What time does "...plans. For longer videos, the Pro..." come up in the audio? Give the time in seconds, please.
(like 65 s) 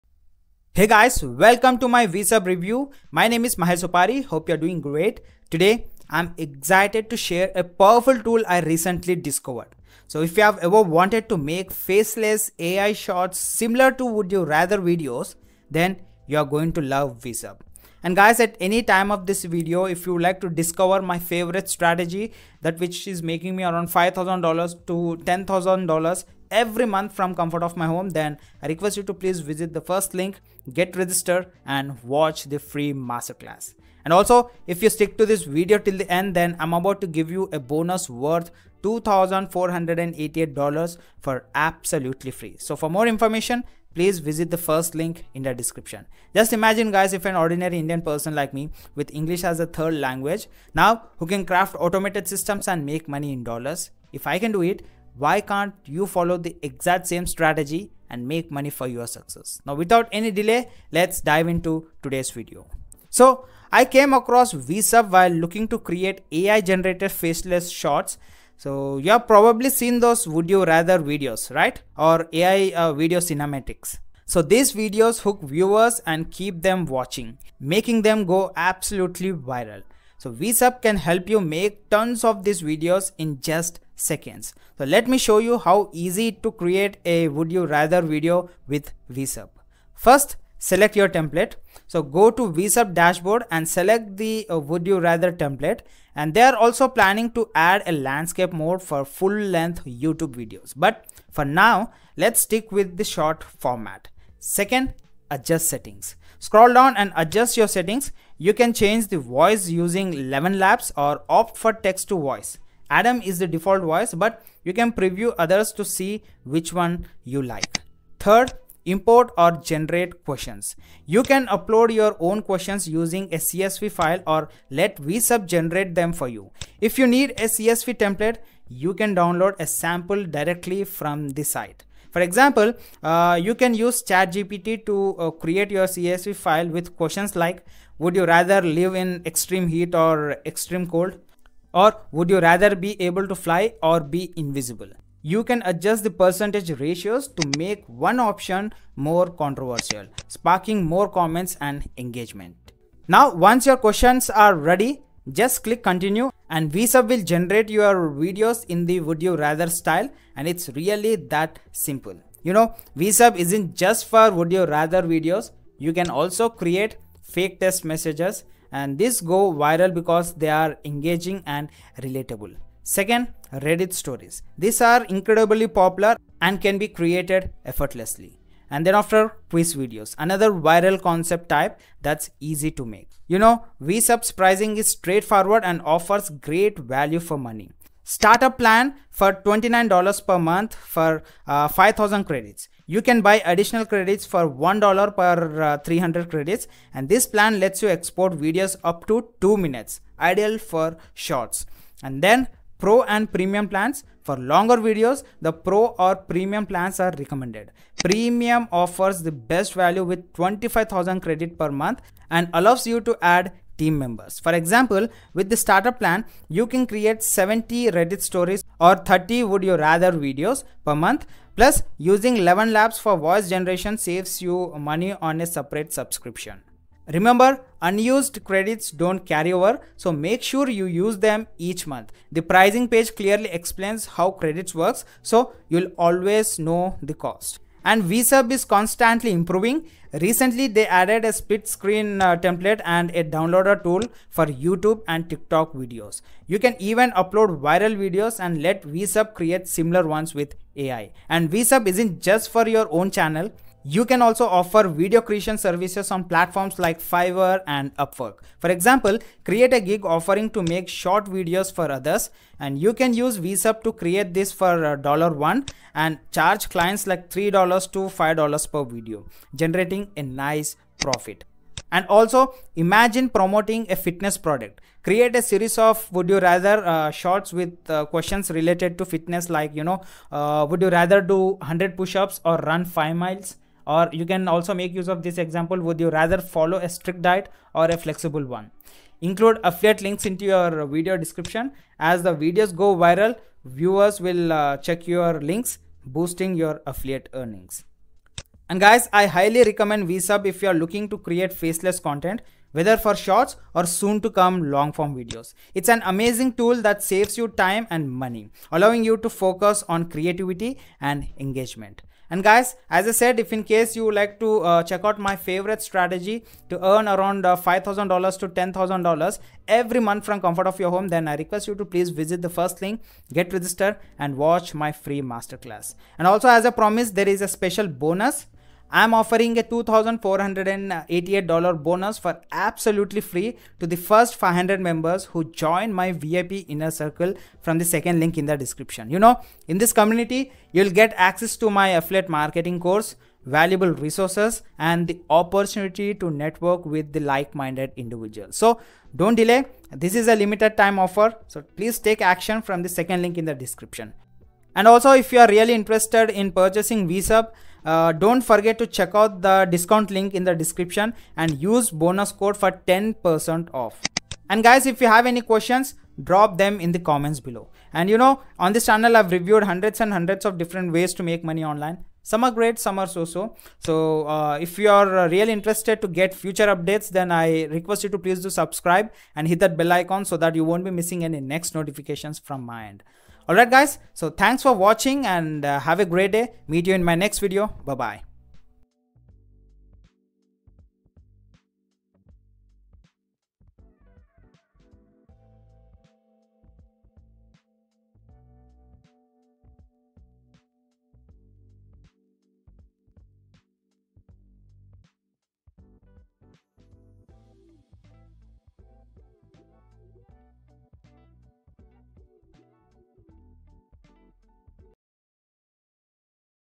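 203 s.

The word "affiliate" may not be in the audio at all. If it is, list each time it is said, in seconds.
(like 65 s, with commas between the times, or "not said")
289 s, 296 s, 341 s.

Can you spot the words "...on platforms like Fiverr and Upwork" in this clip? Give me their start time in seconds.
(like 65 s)
256 s.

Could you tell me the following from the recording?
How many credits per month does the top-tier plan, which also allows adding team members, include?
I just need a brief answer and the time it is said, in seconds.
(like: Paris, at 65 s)
25,000, at 210 s.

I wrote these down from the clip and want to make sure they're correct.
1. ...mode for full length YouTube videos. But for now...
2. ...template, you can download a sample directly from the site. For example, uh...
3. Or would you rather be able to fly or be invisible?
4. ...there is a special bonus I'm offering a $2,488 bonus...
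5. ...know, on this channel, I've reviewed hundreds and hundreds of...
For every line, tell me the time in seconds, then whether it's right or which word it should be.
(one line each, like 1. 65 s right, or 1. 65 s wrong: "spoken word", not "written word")
1. 98 s right
2. 127 s right
3. 141 s right
4. 327 s right
5. 368 s right.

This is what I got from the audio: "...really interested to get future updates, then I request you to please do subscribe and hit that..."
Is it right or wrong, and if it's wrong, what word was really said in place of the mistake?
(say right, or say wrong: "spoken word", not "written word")
right.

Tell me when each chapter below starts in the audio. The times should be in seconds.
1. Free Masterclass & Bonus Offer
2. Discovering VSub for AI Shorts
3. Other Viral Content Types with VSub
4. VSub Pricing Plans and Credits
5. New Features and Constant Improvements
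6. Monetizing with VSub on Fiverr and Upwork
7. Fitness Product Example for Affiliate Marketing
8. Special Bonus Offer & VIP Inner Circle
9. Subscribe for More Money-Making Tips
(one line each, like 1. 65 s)
1. 32 s
2. 64 s
3. 176 s
4. 212 s
5. 247 s
6. 282 s
7. 314 s
8. 345 s
9. 375 s.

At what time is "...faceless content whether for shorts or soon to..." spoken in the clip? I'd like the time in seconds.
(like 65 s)
301 s.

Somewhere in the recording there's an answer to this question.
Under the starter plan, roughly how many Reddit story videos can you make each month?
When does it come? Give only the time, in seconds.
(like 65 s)
217 s.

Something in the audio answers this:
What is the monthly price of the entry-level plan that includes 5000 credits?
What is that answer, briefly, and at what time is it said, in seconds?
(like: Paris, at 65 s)
$29, at 189 s.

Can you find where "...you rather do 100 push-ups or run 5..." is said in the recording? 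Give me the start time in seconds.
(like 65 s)
280 s.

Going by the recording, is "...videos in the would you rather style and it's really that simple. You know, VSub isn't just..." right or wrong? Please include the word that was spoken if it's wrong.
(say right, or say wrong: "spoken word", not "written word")
right.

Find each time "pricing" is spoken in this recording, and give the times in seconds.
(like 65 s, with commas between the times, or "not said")
184 s, 232 s.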